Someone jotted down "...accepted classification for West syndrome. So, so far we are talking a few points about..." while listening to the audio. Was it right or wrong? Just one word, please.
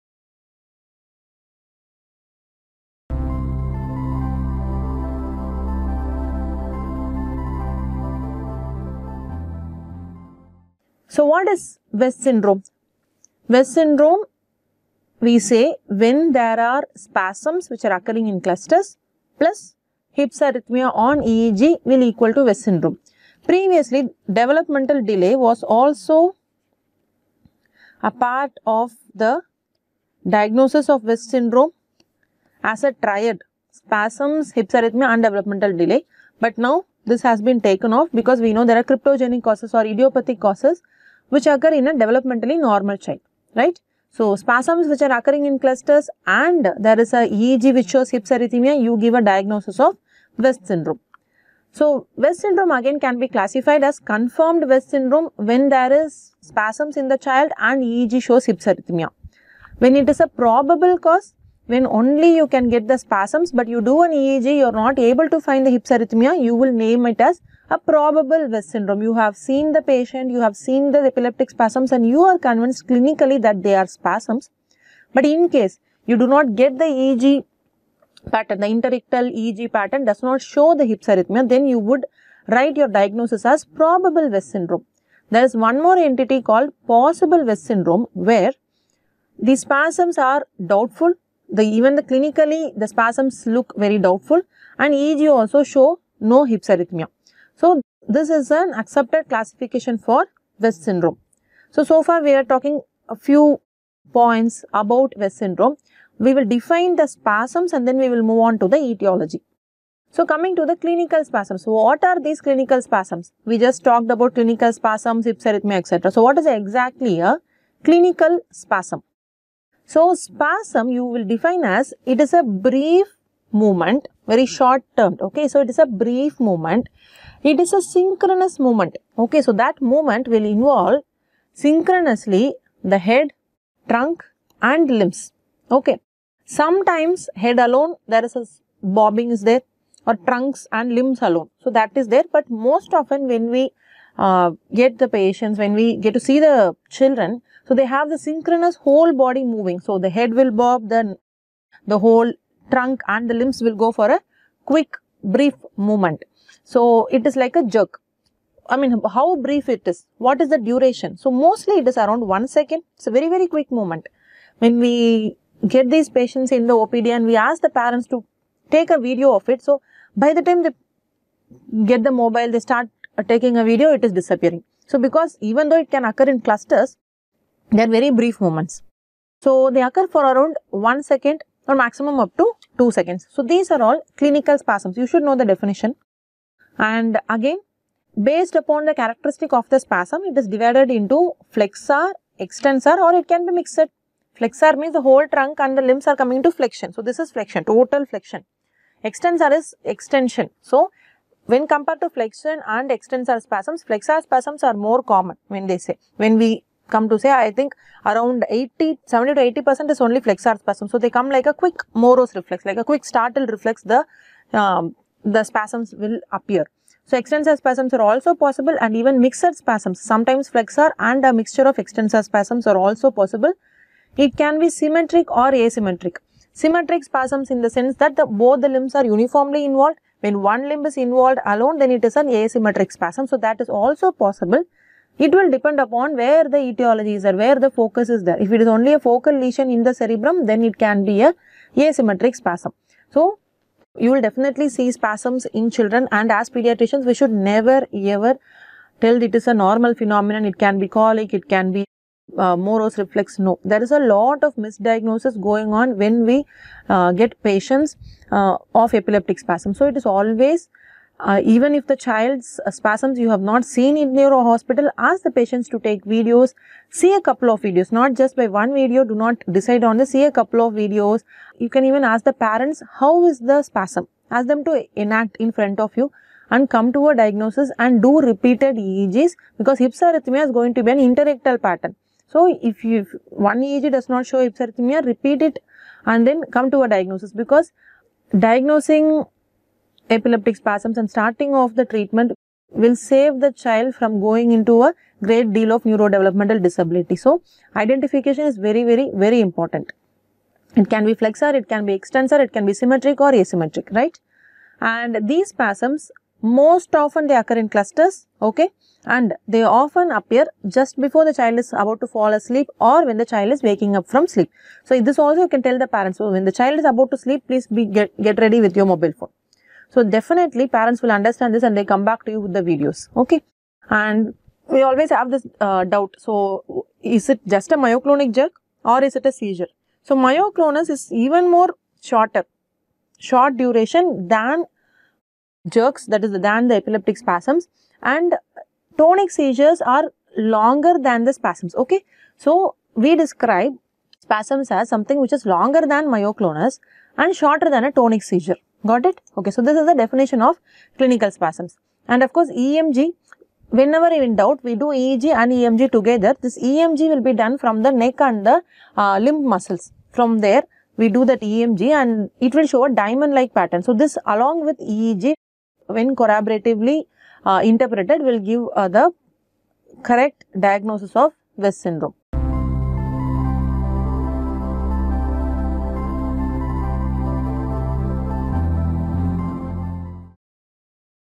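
right.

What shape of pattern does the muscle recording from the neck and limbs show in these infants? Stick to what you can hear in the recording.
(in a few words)
diamond-like pattern.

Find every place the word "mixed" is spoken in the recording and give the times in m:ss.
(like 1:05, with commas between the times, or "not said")
3:13, 3:39.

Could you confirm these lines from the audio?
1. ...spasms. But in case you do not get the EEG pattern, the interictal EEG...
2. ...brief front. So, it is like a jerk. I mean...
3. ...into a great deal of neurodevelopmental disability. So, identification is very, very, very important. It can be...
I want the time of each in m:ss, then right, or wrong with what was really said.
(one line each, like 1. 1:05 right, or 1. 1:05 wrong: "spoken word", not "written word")
1. 1:13 right
2. 2:35 wrong: "movement", not "front"
3. 4:54 right.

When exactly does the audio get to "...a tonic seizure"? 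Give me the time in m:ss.
5:47.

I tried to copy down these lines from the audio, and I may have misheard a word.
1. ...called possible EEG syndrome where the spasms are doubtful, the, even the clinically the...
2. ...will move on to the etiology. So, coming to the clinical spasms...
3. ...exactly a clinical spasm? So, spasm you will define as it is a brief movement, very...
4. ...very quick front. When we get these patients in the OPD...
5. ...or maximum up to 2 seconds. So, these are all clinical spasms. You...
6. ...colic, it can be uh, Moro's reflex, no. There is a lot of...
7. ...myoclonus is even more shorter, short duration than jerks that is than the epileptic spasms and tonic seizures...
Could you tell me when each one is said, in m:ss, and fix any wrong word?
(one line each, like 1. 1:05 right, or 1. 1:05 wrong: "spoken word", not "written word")
1. 1:26 wrong: "West", not "EEG"
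2. 1:48 right
3. 1:56 right
4. 2:43 wrong: "movement", not "front"
5. 3:01 right
6. 4:10 right
7. 5:30 right.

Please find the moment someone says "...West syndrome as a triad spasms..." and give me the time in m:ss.
0:31.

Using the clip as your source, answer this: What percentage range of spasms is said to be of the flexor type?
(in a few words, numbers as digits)
70 to 80 percent.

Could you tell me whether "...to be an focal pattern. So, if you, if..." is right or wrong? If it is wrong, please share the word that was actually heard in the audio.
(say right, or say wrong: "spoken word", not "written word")
wrong: "interictal", not "focal".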